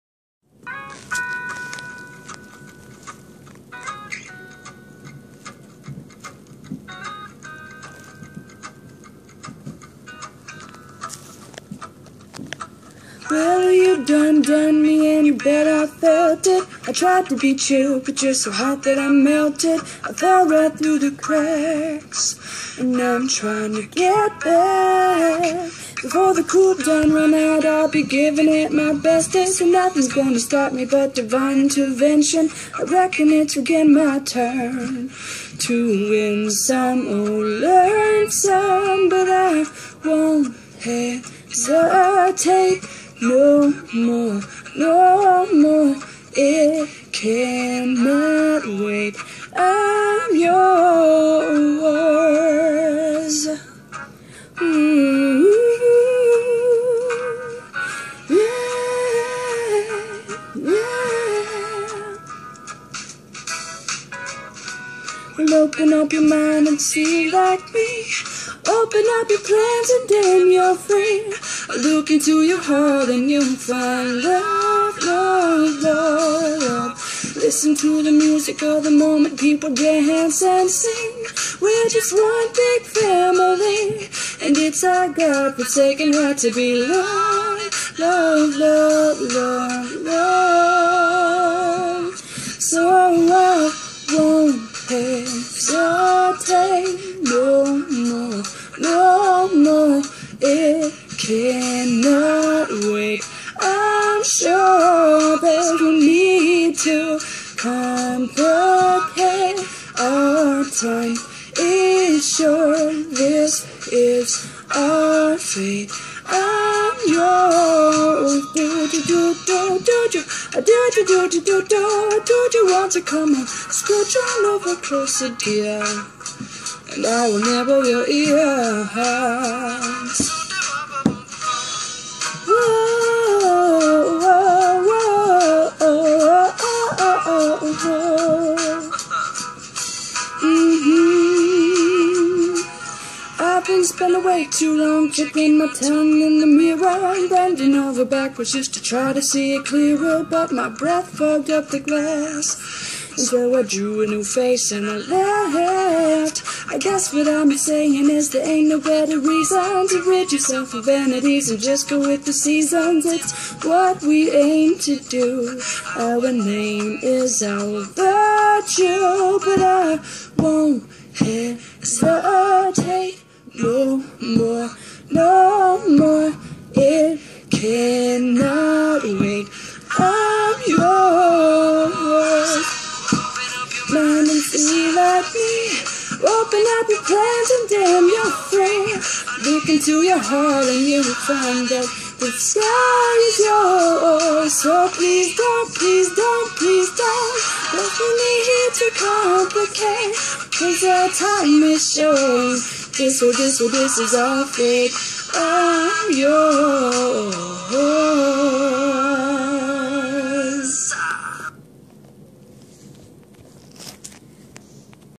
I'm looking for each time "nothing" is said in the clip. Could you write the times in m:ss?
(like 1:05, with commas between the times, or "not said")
0:29, 2:23.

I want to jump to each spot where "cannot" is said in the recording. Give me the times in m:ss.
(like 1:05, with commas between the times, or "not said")
0:47, 1:41, 2:57.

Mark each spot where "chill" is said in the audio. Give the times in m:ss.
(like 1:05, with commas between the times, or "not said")
0:17.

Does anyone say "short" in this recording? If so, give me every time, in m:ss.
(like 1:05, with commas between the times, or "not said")
3:21.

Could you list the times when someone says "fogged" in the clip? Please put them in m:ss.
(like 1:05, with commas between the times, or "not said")
2:31.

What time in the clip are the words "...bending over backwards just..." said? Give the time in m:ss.
2:27.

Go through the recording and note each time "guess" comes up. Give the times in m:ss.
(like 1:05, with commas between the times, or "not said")
2:36.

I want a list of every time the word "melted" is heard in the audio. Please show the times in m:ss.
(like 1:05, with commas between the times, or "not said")
0:19.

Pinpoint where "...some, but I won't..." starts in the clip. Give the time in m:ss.
0:38.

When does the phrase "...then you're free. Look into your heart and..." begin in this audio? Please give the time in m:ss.
1:10.